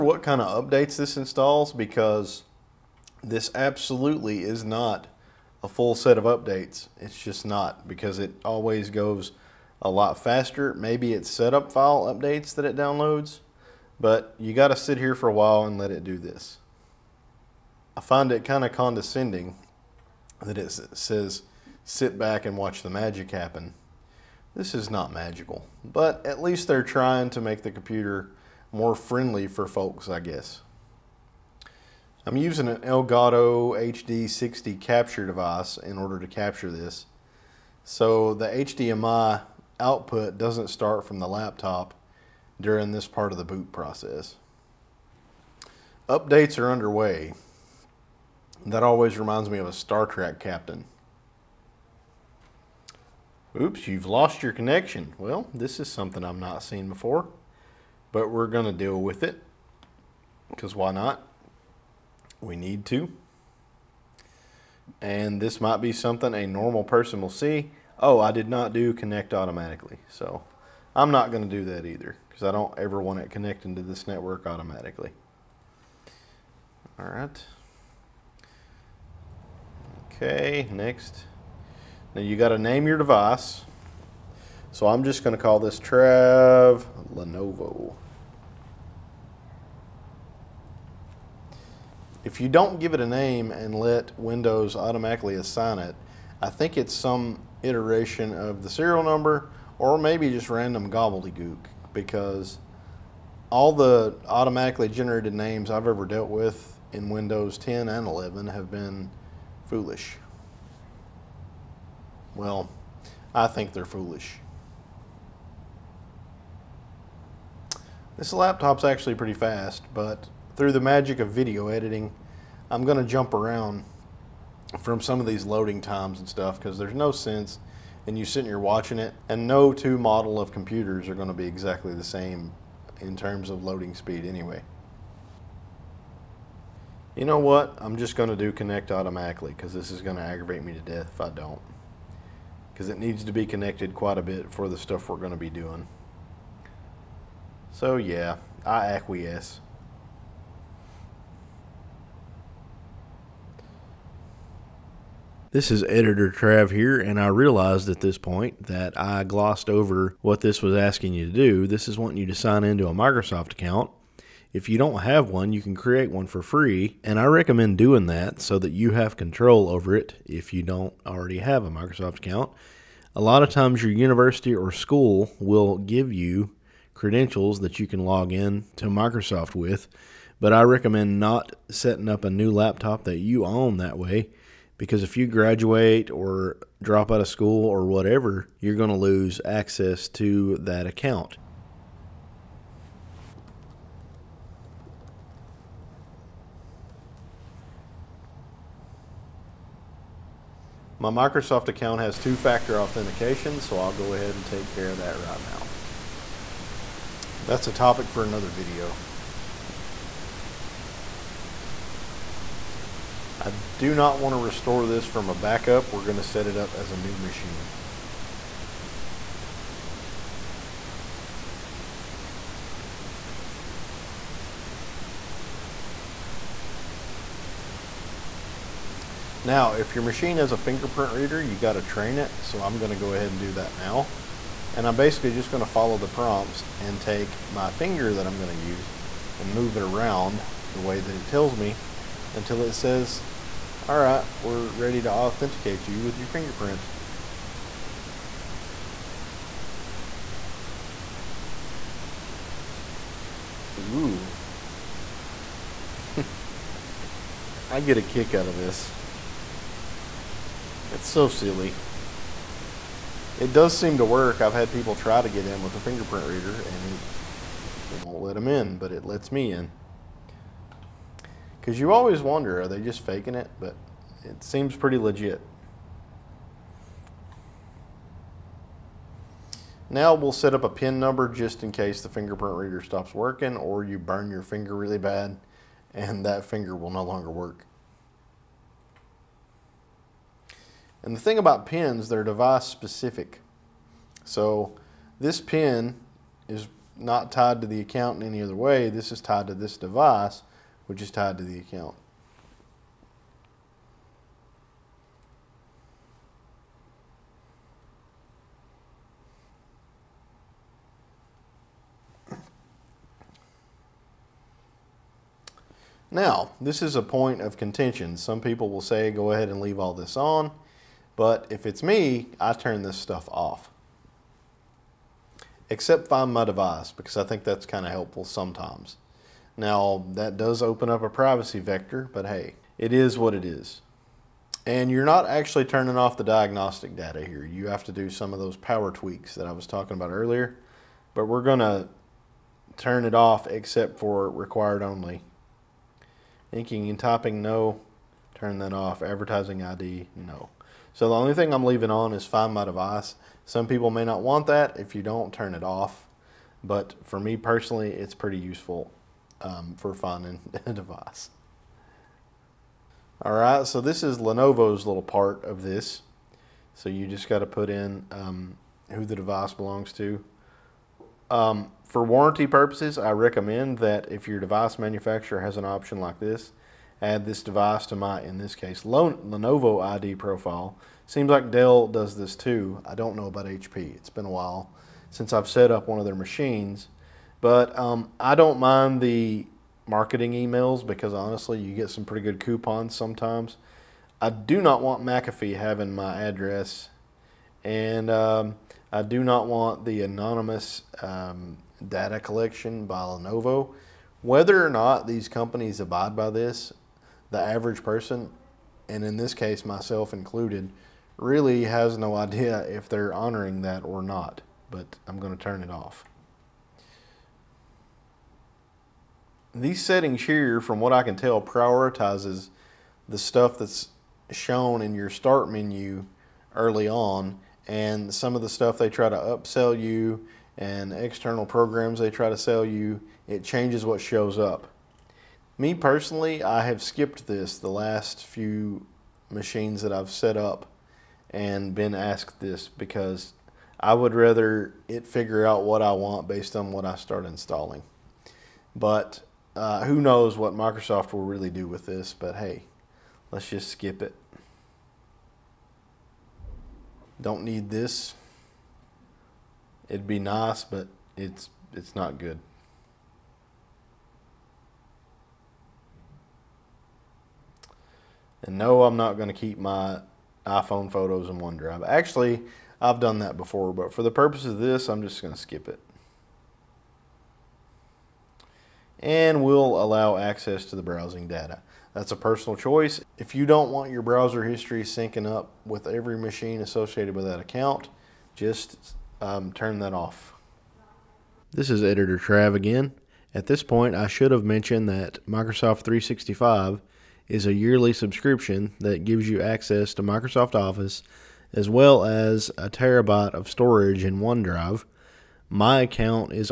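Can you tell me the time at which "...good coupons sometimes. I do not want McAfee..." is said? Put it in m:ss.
6:32.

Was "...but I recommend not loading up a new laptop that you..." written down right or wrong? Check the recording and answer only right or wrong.
wrong.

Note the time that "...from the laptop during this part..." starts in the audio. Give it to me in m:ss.
0:41.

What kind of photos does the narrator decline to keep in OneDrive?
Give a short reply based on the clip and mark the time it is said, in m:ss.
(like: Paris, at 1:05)
iPhone photos, at 7:50.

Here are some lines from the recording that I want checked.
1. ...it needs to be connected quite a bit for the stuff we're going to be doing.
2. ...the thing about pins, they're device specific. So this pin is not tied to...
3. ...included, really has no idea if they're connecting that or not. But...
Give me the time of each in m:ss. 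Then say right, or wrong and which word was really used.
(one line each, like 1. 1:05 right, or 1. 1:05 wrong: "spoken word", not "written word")
1. 2:22 right
2. 4:51 right
3. 6:50 wrong: "honoring", not "connecting".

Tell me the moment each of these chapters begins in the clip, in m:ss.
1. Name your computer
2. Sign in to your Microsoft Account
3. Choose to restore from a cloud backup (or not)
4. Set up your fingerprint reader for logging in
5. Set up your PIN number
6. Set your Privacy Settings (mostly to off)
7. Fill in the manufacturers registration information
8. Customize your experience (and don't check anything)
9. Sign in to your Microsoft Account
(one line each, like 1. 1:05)
1. 1:17
2. 2:33
3. 3:29
4. 3:44
5. 4:38
6. 5:10
7. 6:01
8. 6:58
9. 8:02.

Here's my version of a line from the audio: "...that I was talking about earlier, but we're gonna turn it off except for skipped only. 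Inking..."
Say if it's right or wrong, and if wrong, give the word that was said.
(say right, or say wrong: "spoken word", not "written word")
wrong: "required", not "skipped".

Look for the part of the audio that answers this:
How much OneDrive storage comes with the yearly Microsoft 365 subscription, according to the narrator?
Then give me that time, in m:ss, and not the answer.
8:22.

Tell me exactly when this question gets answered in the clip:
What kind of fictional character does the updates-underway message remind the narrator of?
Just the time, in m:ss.
0:49.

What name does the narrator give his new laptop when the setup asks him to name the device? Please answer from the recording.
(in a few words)
Trav Lenovo.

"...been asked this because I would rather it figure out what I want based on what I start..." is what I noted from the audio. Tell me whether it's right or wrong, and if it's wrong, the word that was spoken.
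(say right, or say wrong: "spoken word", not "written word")
right.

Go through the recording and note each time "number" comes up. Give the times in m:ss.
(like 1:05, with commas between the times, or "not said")
1:39, 4:40.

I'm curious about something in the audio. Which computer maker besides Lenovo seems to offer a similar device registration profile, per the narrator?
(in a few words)
Dell.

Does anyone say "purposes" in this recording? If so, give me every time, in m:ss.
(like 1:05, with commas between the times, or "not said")
6:12, 7:54.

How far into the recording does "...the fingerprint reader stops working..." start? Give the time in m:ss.
4:42.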